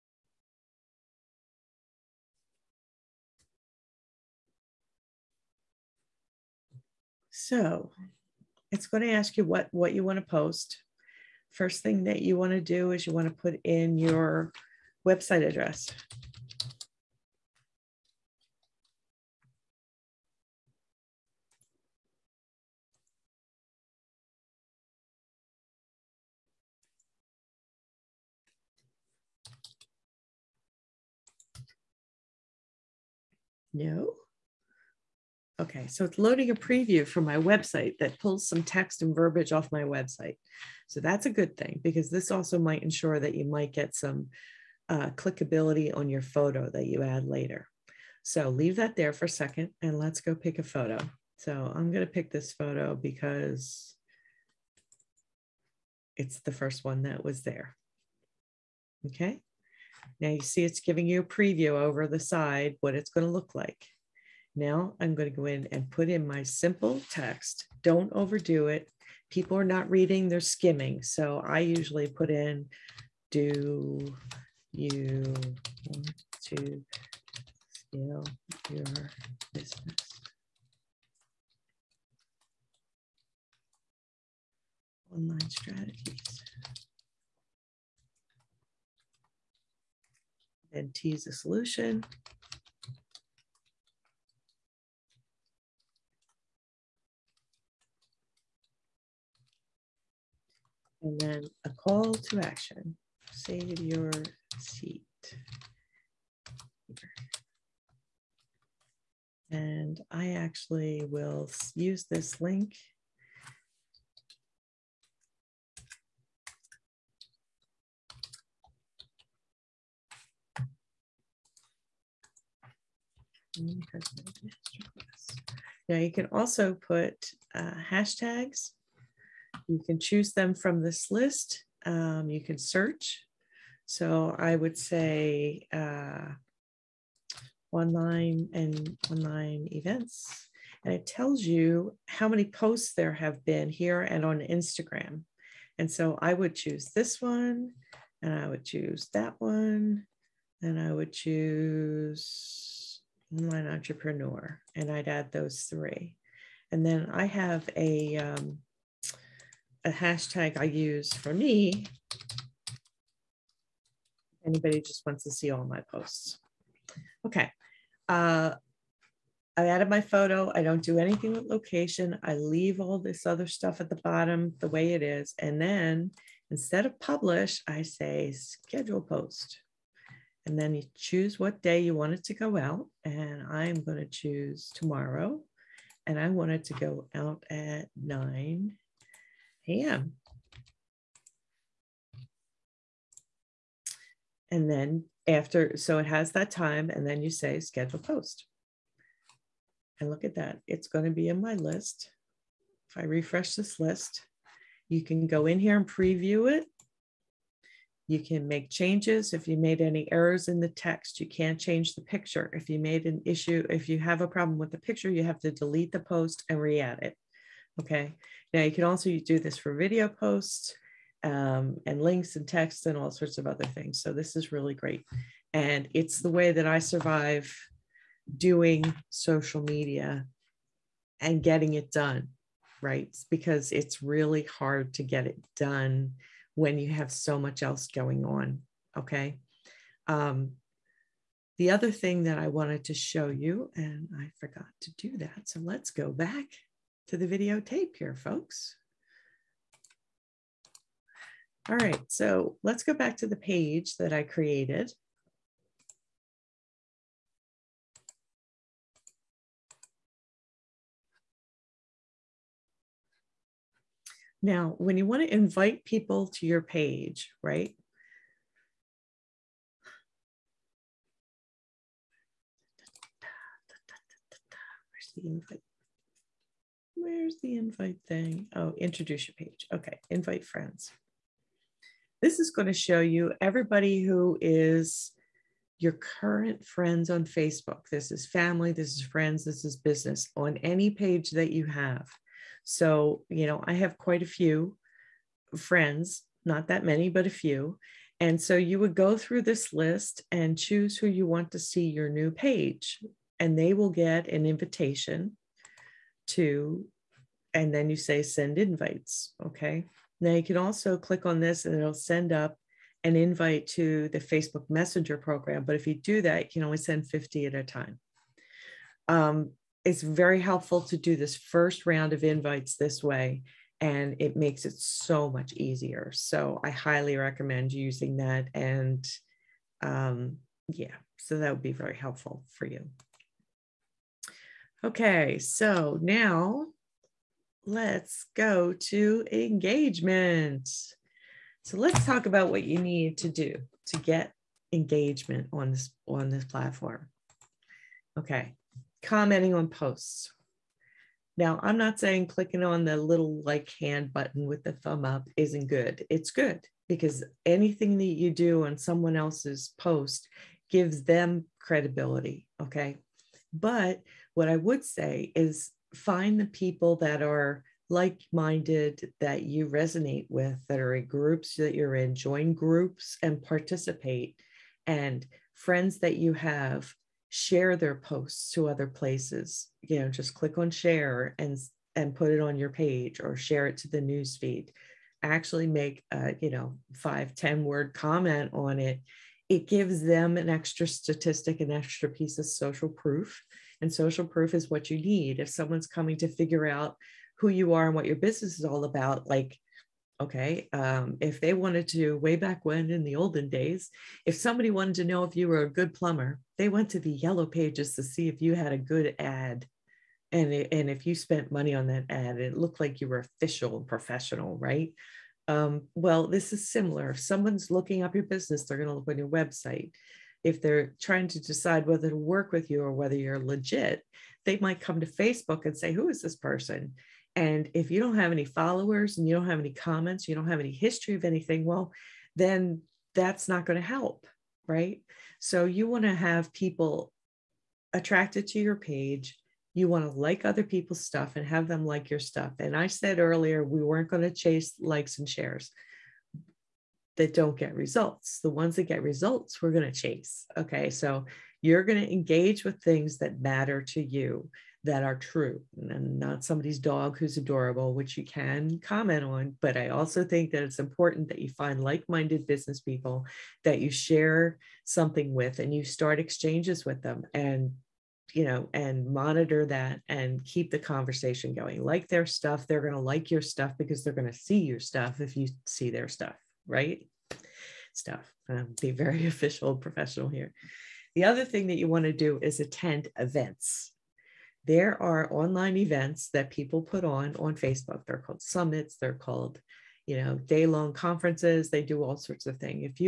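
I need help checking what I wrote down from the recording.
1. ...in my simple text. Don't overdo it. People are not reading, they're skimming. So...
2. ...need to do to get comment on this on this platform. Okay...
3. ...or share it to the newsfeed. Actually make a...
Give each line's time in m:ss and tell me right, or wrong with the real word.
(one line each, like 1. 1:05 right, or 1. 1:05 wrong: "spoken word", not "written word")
1. 1:06 right
2. 5:42 wrong: "engagement", not "comment"
3. 6:23 right.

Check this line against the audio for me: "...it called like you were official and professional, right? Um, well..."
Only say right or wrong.
wrong.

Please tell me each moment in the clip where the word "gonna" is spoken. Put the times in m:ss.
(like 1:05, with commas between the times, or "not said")
0:51, 1:03.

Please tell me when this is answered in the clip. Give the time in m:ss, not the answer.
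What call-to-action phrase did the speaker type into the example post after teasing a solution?
1:43.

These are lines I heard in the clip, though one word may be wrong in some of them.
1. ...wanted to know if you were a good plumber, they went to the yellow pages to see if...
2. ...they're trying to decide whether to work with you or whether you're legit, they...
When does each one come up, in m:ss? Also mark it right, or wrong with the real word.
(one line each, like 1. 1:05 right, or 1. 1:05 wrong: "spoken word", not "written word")
1. 6:44 right
2. 7:00 right.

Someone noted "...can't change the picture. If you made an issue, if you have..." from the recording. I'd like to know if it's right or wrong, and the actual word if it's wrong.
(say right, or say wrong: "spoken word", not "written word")
right.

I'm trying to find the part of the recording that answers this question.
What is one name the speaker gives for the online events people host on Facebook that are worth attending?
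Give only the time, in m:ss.
8:08.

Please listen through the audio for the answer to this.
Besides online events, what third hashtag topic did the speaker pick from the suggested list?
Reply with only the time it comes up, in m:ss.
2:33.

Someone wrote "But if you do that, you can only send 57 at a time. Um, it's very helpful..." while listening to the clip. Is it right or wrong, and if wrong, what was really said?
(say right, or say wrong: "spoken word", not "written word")
wrong: "50", not "57".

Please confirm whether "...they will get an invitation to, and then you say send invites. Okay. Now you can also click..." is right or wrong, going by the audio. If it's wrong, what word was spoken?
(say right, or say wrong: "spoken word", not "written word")
right.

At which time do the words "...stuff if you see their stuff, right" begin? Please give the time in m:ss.
7:54.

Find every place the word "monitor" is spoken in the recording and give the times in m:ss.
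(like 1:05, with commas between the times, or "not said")
7:49.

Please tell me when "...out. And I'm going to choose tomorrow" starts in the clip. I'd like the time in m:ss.
3:02.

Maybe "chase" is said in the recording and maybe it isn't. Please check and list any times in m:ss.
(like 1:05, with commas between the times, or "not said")
7:24, 7:29.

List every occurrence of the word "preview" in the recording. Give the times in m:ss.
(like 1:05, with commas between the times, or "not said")
0:36, 1:01, 3:25.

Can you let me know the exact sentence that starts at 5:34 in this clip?
Okay, so now let's go to engagement.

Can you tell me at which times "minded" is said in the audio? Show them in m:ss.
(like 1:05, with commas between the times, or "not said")
6:08, 7:42.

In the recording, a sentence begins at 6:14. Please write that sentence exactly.
And friends that you have share their posts to other places.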